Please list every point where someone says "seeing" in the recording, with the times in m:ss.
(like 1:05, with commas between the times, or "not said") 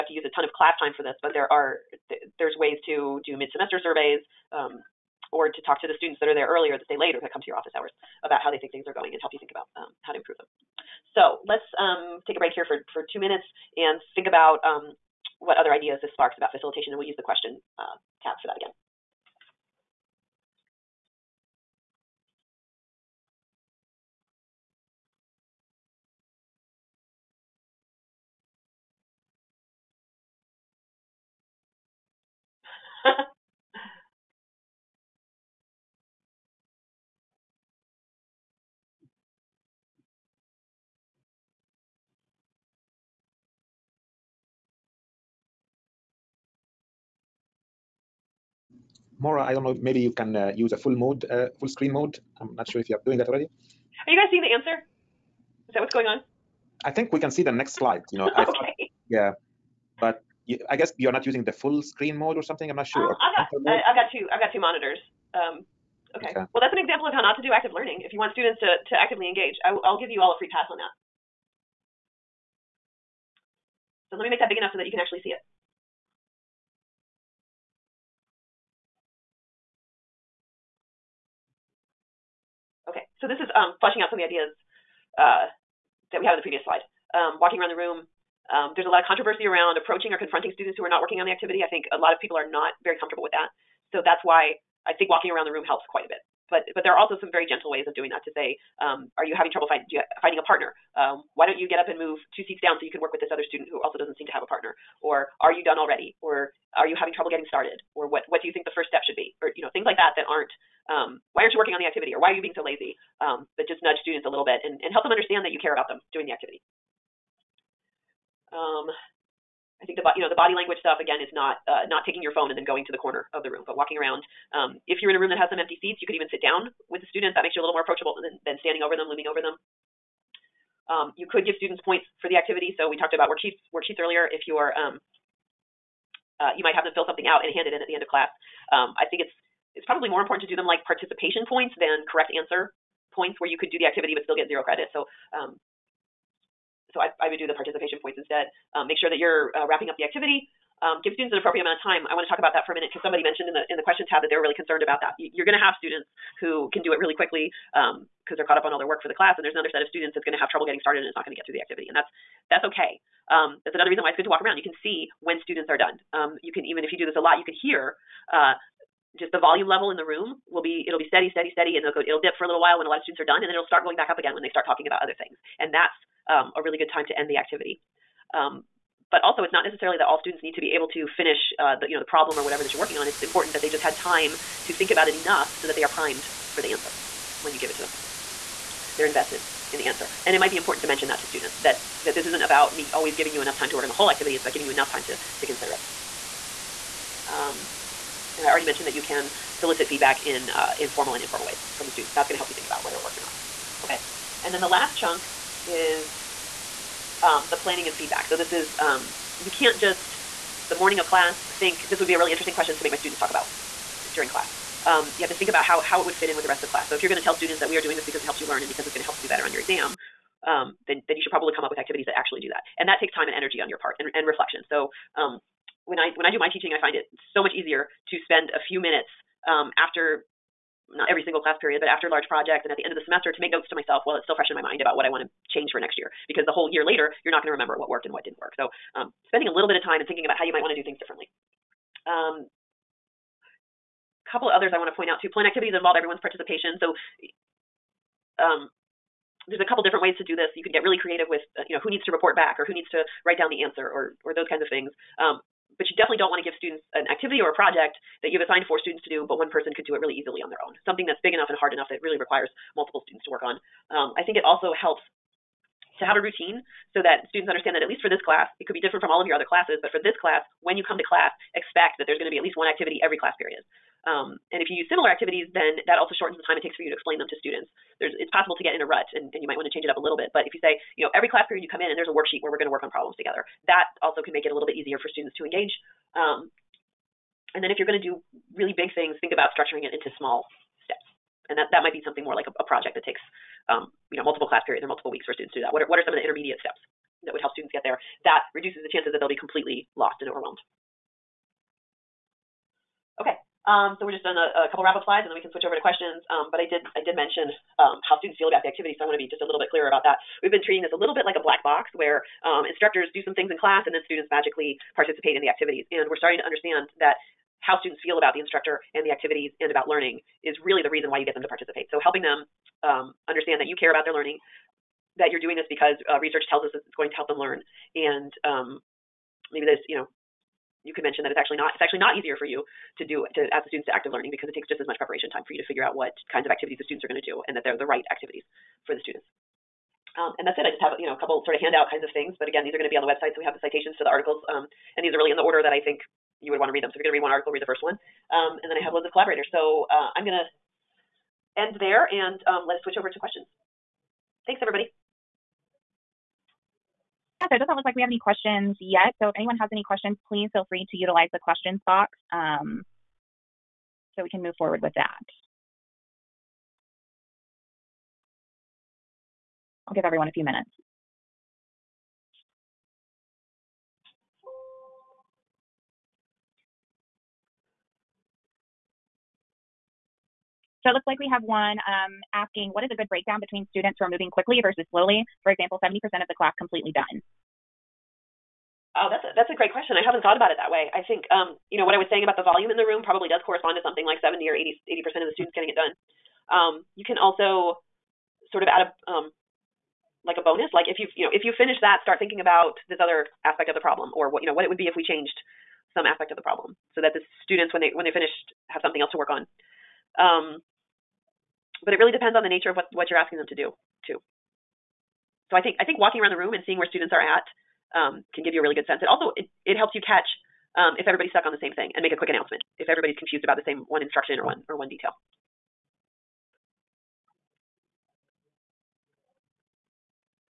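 0:54, 6:56.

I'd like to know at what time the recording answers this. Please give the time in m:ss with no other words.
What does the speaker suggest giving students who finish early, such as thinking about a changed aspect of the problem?
6:40.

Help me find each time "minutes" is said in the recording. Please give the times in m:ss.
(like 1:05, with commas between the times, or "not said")
0:13, 2:32, 3:48, 6:10.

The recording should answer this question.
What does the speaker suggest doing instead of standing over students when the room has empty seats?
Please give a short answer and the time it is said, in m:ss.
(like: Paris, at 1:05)
sit down with the students, at 2:06.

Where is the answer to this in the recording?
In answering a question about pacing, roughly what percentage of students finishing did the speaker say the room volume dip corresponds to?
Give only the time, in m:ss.
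6:34.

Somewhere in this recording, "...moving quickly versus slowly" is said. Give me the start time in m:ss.
6:24.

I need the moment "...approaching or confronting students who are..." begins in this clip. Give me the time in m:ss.
1:29.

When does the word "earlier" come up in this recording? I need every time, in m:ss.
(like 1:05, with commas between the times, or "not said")
0:06, 2:13.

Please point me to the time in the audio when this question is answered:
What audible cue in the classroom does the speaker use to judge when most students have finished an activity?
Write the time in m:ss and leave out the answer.
2:49.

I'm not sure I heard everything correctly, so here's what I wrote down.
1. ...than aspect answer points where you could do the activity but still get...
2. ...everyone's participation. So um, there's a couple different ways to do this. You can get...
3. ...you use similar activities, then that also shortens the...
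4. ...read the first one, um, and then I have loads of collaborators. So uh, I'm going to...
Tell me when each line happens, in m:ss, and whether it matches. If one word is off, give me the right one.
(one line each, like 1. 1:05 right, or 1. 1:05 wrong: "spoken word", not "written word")
1. 2:21 wrong: "correct", not "aspect"
2. 4:05 right
3. 4:34 right
4. 5:47 right.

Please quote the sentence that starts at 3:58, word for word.
So, um, spending a little bit of time and thinking about how you might want to do things differently.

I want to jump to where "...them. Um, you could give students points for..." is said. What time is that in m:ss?
2:09.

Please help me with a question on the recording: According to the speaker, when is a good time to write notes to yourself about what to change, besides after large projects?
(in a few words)
end of the semester.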